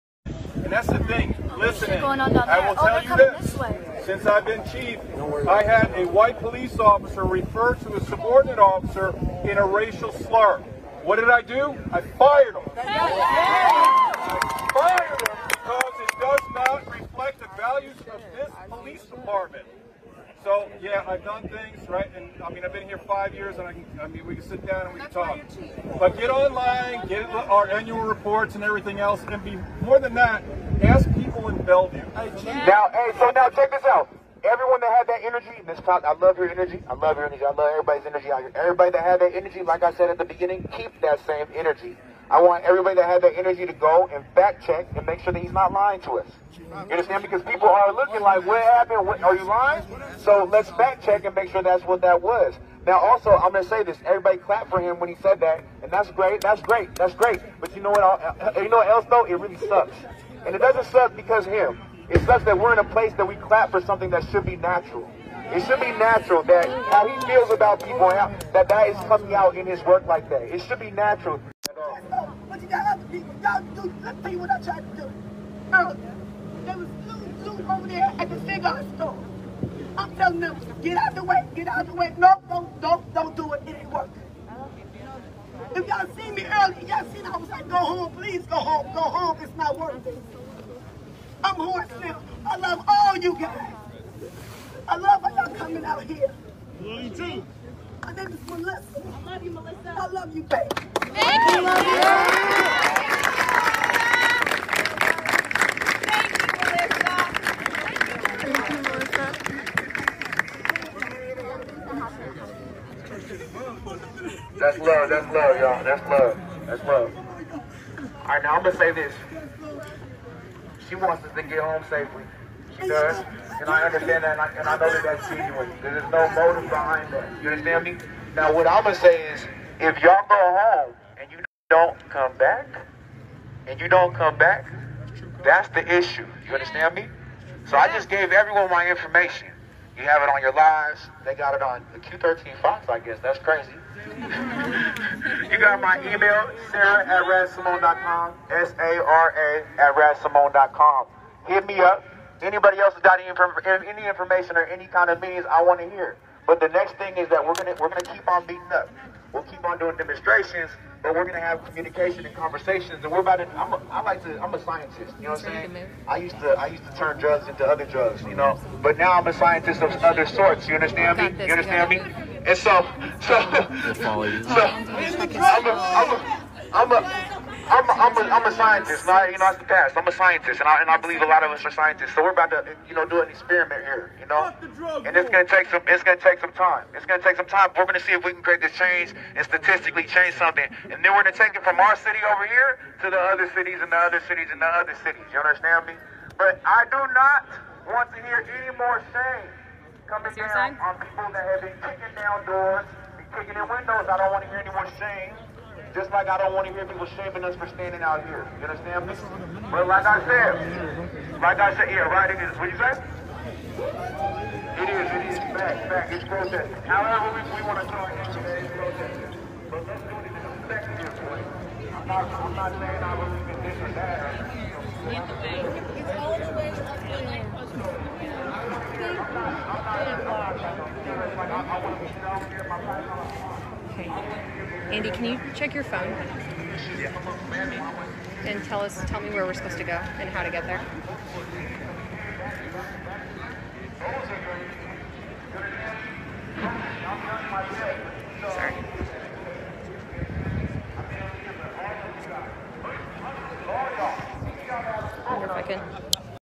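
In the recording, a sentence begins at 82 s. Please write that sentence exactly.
No, don't, don't, don't do it.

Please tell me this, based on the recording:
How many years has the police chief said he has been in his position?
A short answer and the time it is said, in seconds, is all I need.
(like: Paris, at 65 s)
5, at 22 s.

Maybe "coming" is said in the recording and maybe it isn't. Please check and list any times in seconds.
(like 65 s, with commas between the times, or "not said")
69 s, 95 s, 200 s.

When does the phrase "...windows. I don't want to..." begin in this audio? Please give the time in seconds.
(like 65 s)
203 s.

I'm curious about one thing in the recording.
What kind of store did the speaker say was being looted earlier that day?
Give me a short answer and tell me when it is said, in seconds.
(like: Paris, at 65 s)
Cigar store, at 78 s.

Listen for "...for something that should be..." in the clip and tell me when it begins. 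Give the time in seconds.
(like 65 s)
63 s.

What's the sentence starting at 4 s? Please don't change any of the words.
Since I've been chief, I had a white police officer refer to a subordinate officer in a racial slur.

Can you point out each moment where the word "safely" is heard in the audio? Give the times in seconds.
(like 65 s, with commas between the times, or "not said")
121 s.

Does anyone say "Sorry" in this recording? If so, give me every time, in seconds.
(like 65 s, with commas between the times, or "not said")
248 s.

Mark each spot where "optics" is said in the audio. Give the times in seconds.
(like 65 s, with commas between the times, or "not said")
not said.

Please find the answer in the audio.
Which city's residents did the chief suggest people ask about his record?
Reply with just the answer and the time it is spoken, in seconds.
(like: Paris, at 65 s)
Bellevue, at 31 s.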